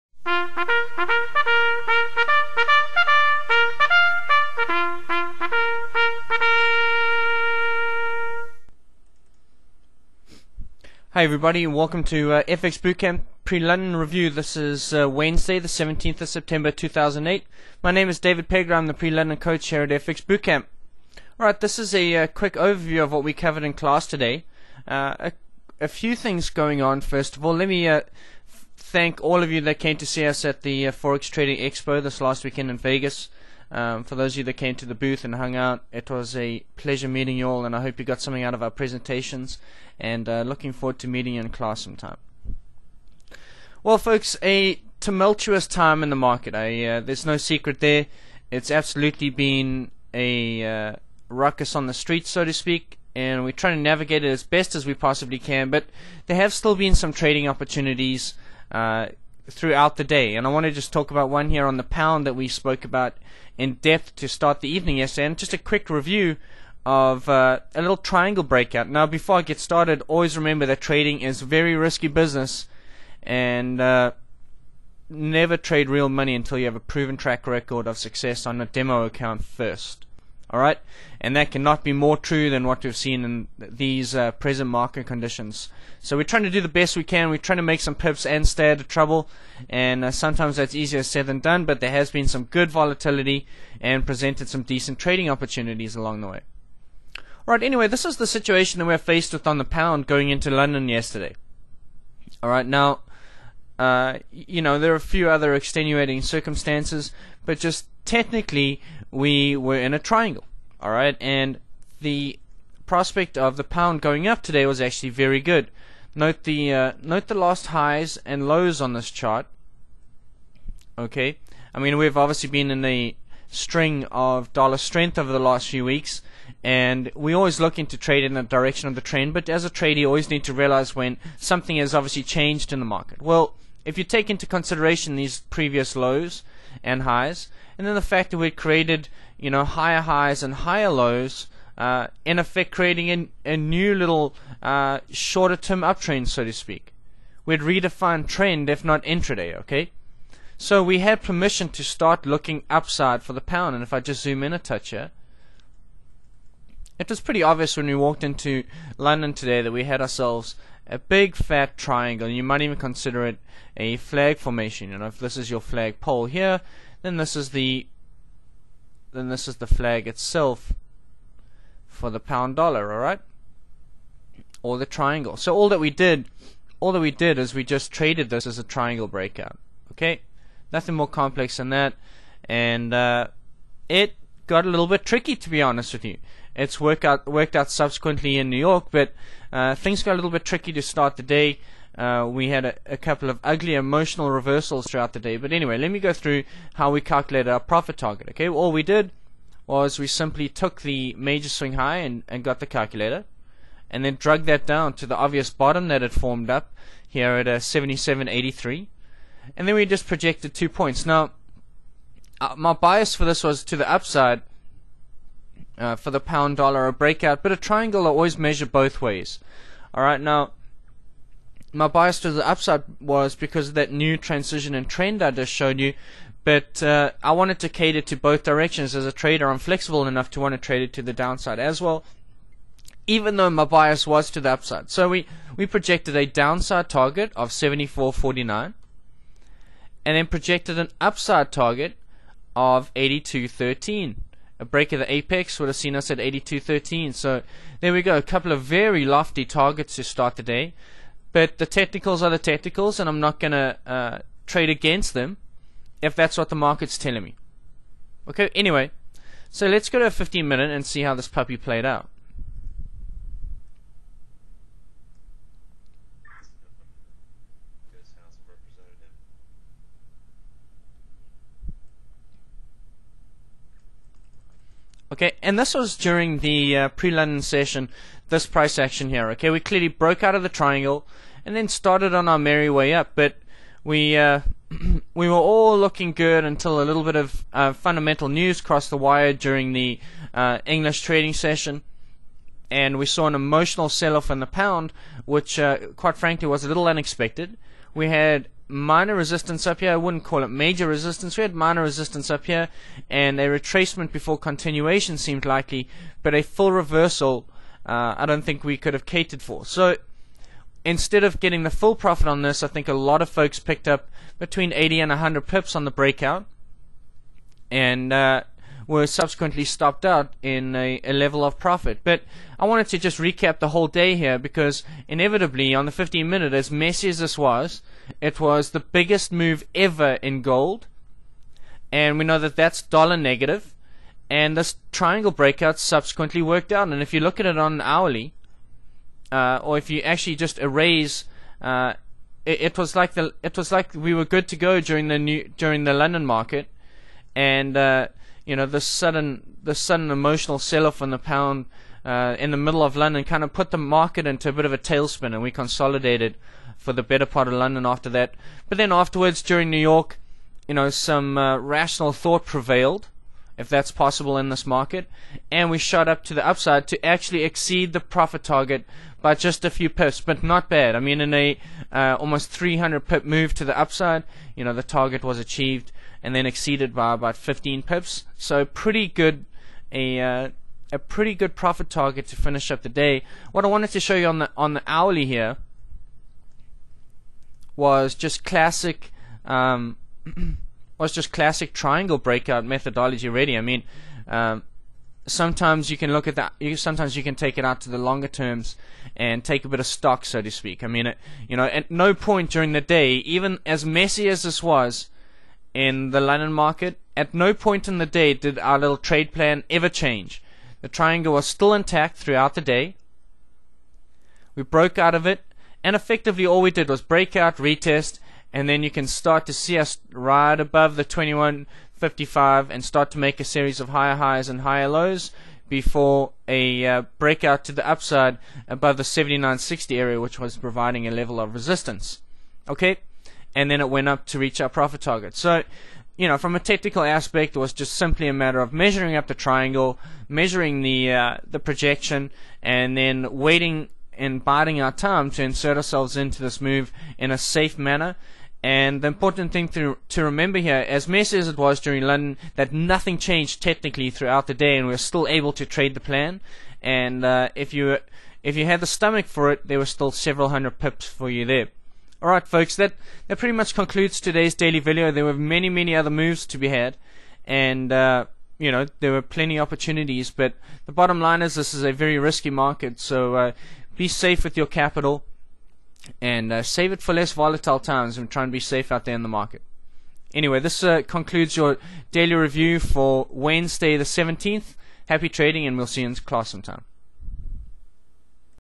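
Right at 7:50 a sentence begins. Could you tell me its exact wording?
But the bottom line is this is a very risky market.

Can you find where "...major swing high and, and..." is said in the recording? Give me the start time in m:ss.
3:21.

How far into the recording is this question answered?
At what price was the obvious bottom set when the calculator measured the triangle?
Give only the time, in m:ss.
3:27.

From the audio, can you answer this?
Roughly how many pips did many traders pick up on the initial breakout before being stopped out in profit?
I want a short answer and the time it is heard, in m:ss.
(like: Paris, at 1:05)
80 to 100, at 5:14.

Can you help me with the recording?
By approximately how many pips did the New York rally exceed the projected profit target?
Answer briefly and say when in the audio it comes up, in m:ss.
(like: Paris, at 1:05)
15, at 6:17.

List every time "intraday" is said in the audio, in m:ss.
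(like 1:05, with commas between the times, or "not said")
2:29.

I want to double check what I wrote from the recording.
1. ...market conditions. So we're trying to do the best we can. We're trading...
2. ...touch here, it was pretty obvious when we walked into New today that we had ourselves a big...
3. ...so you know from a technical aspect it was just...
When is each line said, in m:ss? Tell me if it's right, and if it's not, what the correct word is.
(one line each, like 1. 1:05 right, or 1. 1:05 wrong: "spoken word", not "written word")
1. 1:24 wrong: "trying", not "trading"
2. 2:34 wrong: "London", not "New"
3. 7:15 right.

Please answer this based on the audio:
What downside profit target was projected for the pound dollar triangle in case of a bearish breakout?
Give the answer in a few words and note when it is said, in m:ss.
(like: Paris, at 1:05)
74.49, at 3:57.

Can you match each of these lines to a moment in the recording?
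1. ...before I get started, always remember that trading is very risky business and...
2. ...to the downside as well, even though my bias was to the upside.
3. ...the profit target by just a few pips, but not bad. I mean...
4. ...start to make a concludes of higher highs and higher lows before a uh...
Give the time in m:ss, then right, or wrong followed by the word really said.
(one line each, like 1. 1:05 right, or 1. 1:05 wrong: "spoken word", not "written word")
1. 1:09 right
2. 3:50 right
3. 6:07 right
4. 7:02 wrong: "series", not "concludes".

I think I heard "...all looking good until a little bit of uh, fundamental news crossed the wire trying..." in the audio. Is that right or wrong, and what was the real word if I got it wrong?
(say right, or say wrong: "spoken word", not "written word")
wrong: "during", not "trying".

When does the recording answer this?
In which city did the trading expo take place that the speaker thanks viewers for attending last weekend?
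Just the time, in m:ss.
0:32.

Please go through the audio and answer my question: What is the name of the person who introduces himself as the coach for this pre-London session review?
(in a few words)
David Pegler.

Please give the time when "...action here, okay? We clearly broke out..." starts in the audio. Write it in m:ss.
4:38.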